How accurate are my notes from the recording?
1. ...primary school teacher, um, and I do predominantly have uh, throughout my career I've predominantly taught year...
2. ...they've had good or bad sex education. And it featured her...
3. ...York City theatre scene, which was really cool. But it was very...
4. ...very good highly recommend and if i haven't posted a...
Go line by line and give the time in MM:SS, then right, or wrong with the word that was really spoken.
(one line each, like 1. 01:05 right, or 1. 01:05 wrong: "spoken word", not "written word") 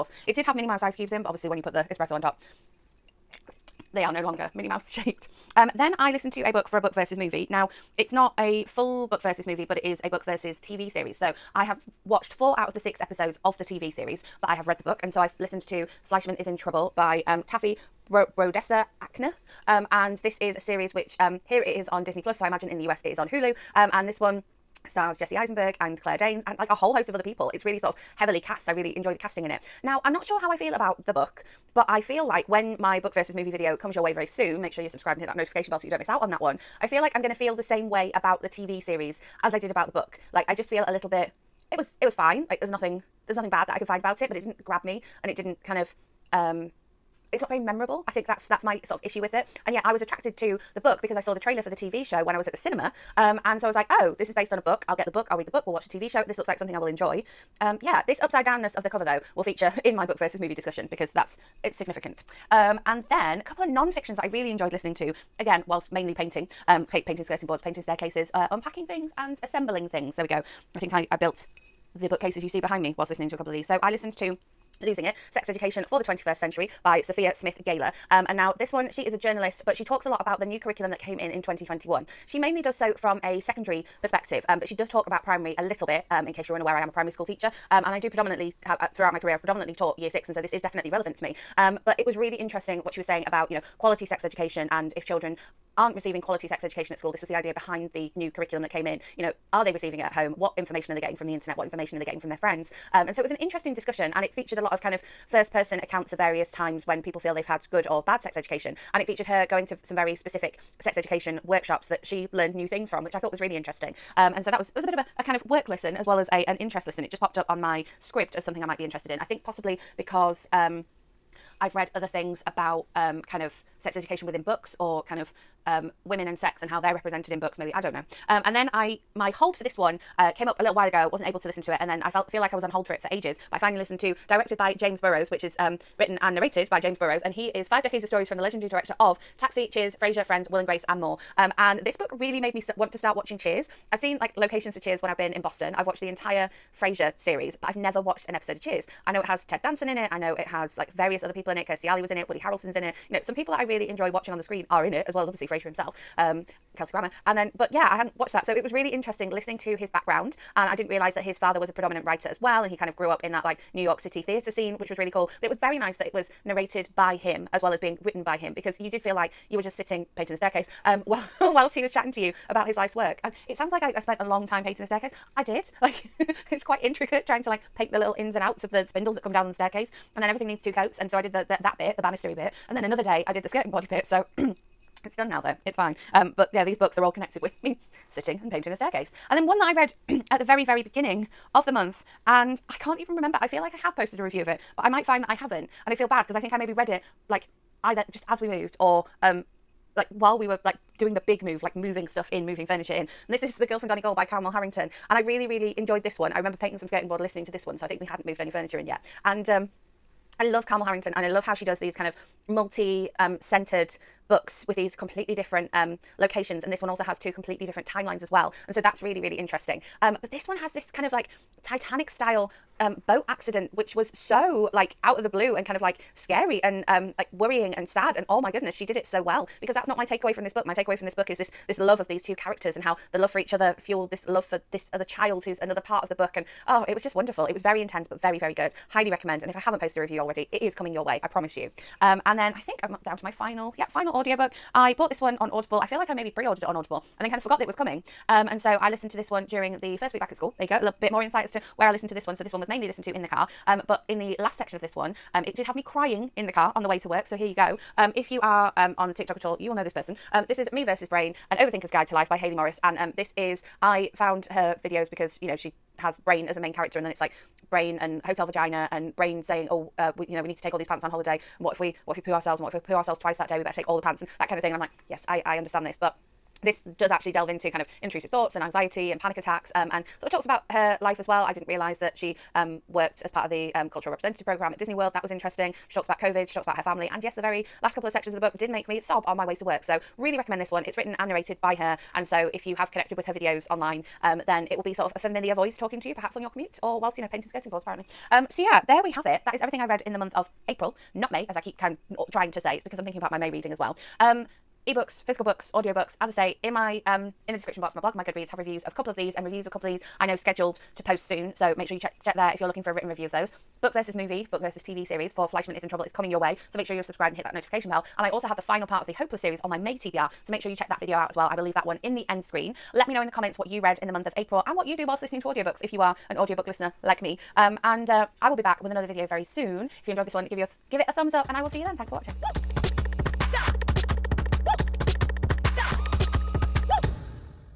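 1. 01:26 right
2. 01:47 right
3. 02:43 right
4. 03:58 right.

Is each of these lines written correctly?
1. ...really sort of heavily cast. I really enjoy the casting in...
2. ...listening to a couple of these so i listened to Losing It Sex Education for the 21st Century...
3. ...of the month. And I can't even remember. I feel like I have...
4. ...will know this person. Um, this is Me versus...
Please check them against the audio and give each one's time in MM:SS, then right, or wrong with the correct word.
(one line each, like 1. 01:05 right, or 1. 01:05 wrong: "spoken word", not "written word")
1. 00:27 right
2. 01:13 right
3. 03:11 right
4. 04:19 right.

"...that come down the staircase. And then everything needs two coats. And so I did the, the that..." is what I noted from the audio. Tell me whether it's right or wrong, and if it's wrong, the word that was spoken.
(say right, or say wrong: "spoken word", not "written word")
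right.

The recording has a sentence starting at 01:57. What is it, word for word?
It just popped up on my Scribd as something I might be interested in.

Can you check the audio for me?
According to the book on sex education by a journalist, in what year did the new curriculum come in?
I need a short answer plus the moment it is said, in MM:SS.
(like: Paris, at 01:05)
2021, at 01:21.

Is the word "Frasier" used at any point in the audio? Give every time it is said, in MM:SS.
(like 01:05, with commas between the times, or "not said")
02:19, 02:26, 02:35.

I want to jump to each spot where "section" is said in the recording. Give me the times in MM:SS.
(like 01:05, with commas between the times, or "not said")
04:14, 04:48.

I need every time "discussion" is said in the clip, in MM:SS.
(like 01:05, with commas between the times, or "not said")
01:00, 01:43.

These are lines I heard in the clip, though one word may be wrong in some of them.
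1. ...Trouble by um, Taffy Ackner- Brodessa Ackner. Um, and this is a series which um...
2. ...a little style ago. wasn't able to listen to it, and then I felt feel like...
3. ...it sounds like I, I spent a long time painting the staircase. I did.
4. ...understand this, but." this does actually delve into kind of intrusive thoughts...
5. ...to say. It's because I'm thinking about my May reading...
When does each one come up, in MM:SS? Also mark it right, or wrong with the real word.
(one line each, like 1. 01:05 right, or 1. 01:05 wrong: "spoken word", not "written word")
1. 00:16 wrong: "Bro", not "Ackner"
2. 02:10 wrong: "while", not "style"
3. 02:53 right
4. 04:35 right
5. 05:02 right.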